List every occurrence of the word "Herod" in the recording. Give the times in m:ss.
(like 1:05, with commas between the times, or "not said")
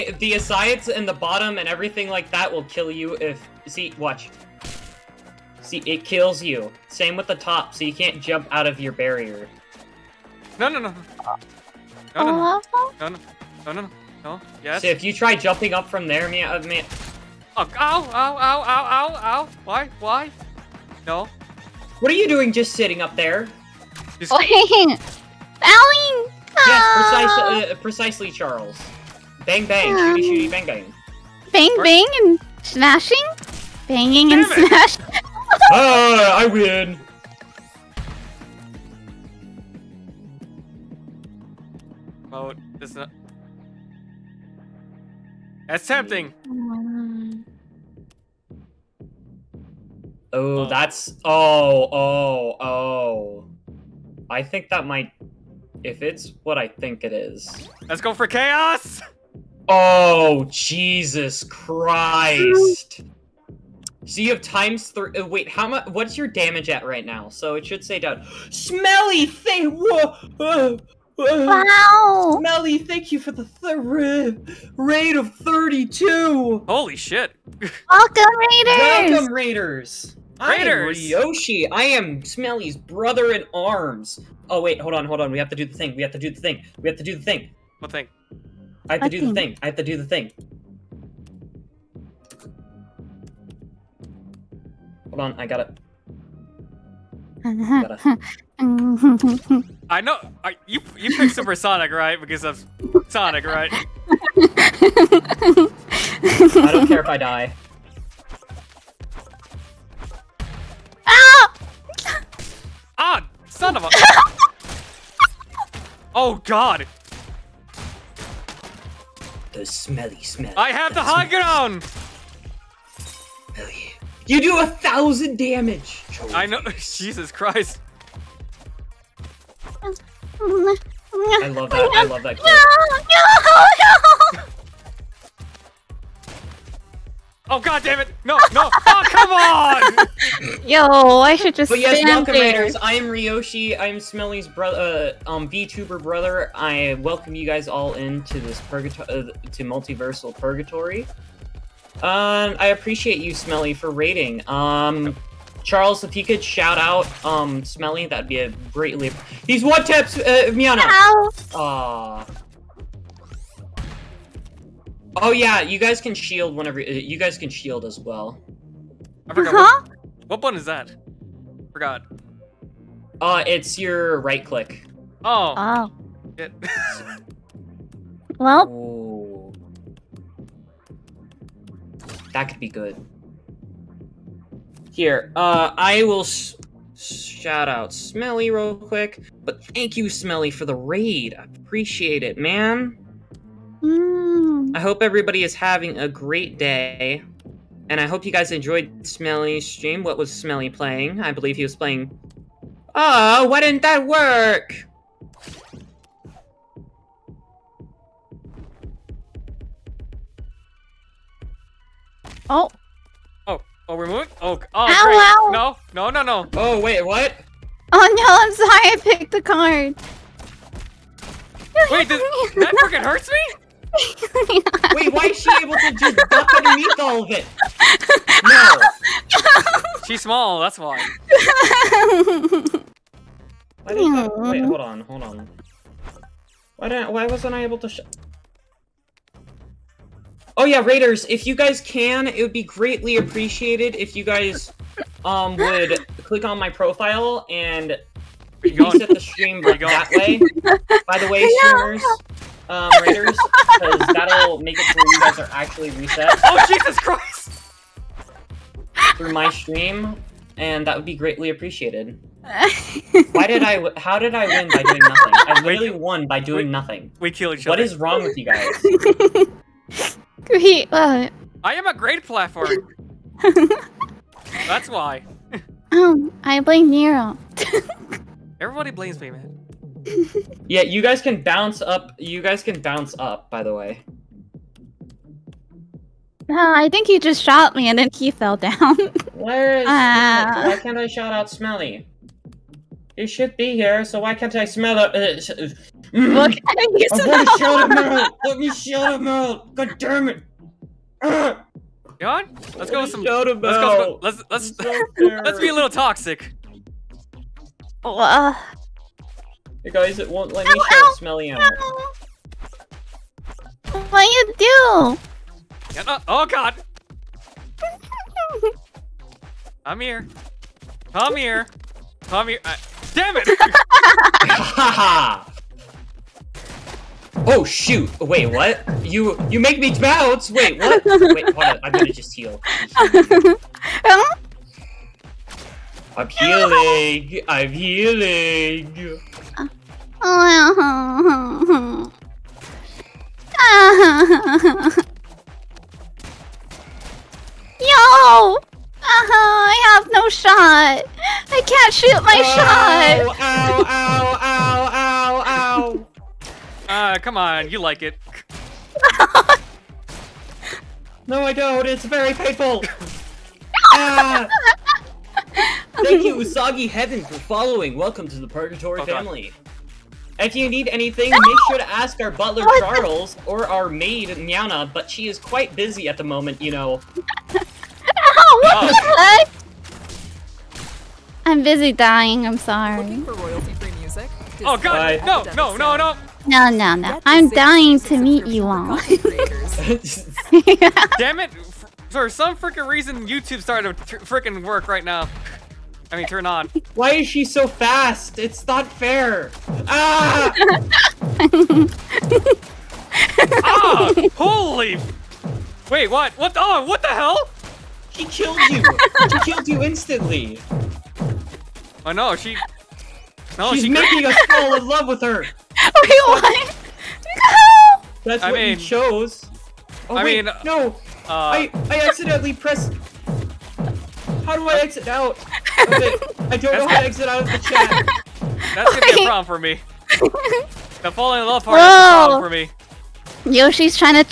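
not said.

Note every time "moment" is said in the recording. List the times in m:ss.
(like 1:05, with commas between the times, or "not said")
6:16.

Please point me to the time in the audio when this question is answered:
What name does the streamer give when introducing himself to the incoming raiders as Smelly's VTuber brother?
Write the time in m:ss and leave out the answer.
2:23.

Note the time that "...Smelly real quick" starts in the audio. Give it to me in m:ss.
3:07.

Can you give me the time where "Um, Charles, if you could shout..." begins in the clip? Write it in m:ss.
2:34.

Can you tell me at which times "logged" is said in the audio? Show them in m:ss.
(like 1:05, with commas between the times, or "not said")
not said.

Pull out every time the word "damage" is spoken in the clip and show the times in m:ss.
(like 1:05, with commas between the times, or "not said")
1:06, 2:05.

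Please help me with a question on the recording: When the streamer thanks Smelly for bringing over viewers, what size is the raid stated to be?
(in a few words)
32.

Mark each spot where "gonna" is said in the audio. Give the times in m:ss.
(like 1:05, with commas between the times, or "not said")
4:57, 5:31, 7:08.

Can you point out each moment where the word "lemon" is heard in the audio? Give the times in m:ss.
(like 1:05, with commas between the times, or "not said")
not said.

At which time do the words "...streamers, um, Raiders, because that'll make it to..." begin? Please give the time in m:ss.
4:11.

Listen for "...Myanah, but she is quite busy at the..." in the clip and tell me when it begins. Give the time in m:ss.
6:14.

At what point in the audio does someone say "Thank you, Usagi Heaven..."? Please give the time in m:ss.
6:06.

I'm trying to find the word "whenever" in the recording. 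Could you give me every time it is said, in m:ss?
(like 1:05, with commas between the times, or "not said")
2:46.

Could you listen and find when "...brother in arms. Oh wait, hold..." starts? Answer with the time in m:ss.
1:22.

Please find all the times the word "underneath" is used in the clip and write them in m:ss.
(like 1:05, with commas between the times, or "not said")
3:46.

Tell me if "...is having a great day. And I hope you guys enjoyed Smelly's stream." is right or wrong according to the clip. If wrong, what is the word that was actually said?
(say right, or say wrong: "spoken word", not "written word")
right.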